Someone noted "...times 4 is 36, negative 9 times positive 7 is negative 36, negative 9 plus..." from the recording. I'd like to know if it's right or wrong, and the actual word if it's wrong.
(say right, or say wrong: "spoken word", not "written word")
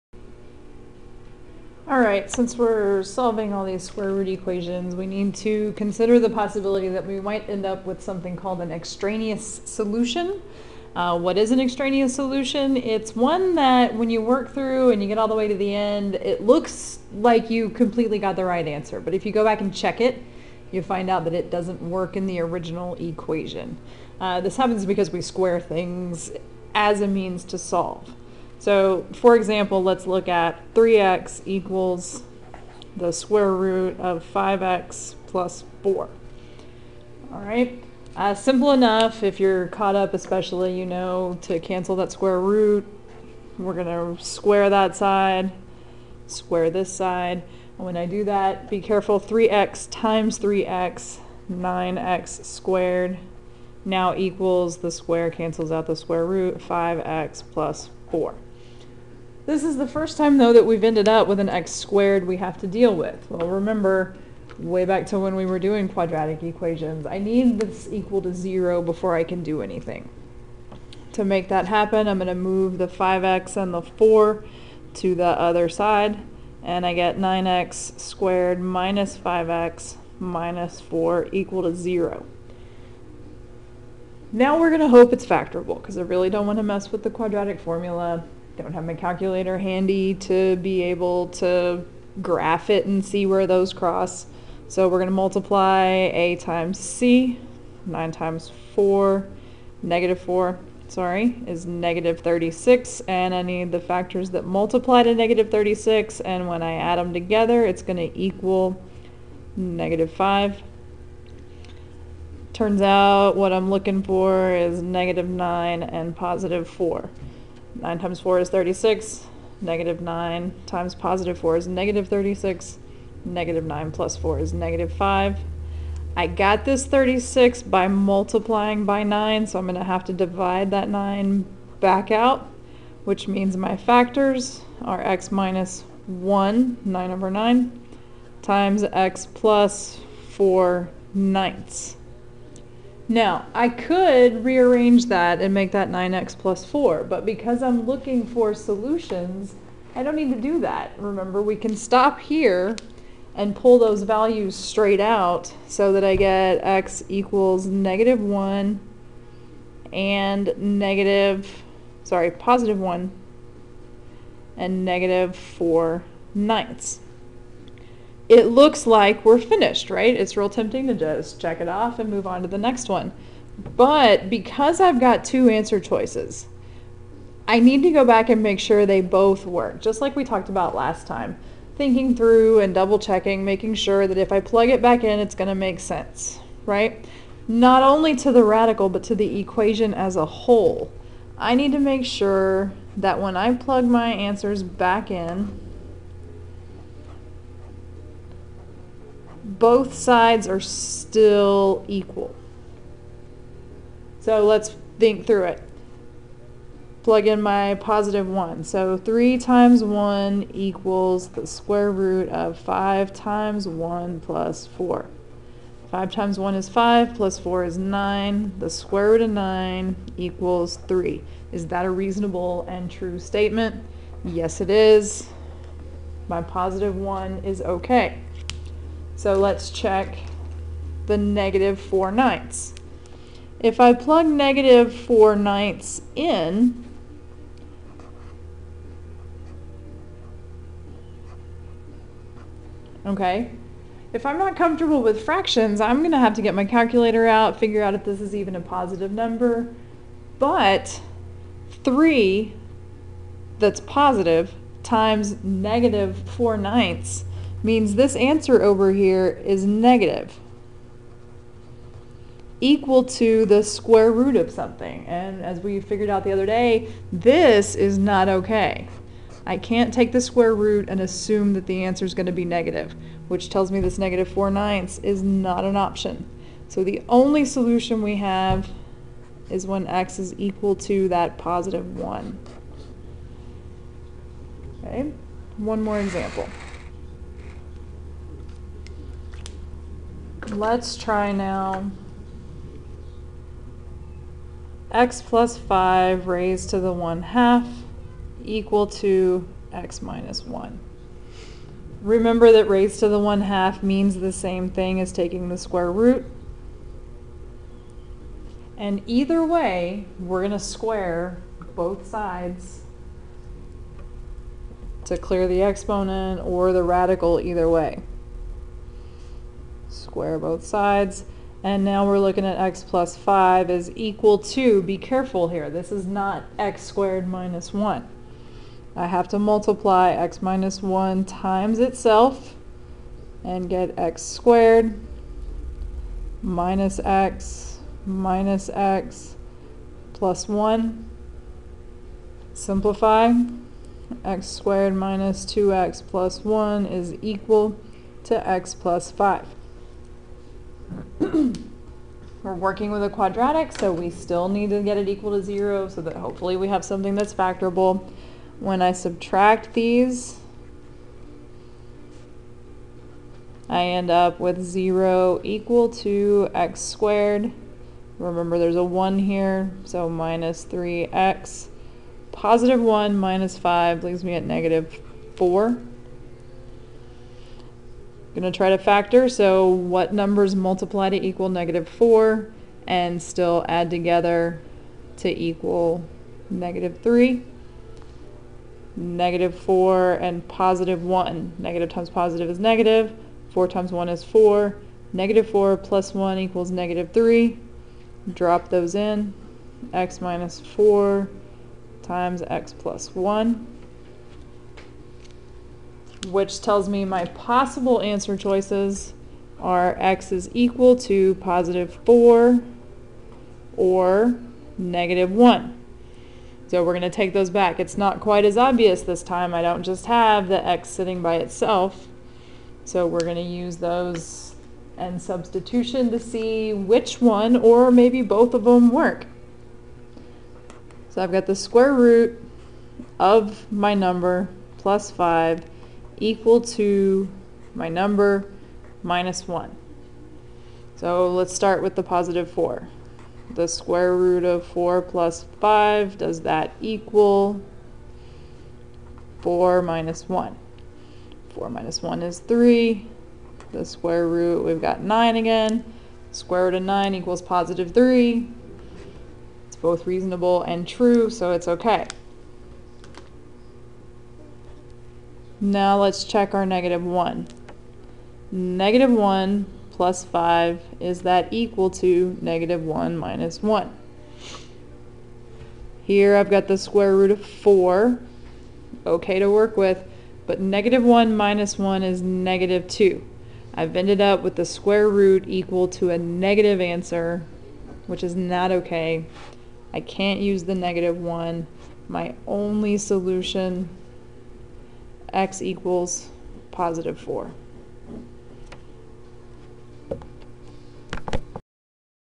wrong: "4", not "7".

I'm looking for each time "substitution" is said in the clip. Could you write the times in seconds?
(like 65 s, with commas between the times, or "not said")
425 s.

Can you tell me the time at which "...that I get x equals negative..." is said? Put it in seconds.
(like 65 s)
155 s.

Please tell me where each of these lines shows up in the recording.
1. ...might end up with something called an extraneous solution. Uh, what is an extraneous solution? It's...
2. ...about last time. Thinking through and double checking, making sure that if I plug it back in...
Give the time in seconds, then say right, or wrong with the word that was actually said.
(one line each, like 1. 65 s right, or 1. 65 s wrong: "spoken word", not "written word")
1. 7 s right
2. 180 s right.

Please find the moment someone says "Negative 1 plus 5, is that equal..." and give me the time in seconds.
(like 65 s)
468 s.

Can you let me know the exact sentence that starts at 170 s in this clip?
It's real tempting to just check it off and move on to the next one.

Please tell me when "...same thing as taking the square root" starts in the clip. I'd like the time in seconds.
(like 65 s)
304 s.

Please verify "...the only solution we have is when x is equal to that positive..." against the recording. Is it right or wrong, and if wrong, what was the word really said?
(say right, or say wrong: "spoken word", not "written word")
right.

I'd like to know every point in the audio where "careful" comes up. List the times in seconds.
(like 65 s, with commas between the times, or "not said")
48 s, 324 s.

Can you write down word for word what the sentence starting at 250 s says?
But 3 that's positive times negative 4 ninths means this answer over here is negative equal to the square root of something.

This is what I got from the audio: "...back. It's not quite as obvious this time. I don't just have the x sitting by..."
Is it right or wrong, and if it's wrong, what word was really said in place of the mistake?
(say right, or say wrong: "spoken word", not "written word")
right.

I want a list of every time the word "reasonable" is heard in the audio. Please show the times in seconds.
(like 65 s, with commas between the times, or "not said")
221 s, 460 s.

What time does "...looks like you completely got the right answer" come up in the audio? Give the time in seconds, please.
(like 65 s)
16 s.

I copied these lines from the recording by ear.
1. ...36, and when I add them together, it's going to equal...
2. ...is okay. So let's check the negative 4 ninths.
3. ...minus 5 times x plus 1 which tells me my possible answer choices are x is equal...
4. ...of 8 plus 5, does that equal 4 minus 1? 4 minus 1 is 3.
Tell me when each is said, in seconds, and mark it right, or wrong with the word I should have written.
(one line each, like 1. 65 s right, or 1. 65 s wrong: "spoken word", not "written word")
1. 105 s right
2. 227 s right
3. 400 s wrong: "4", not "5"
4. 444 s wrong: "4", not "8".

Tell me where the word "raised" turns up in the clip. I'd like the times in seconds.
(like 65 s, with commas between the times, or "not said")
296 s, 302 s.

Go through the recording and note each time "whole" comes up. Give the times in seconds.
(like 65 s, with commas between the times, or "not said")
190 s.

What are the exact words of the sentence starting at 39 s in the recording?
If you're caught up, especially, you know, to cancel that square root, we're going to square that side, square this side.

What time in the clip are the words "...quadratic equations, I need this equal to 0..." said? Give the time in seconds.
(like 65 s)
65 s.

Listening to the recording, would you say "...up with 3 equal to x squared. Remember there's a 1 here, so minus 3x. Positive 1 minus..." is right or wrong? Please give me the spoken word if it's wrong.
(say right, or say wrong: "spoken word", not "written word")
wrong: "0", not "3".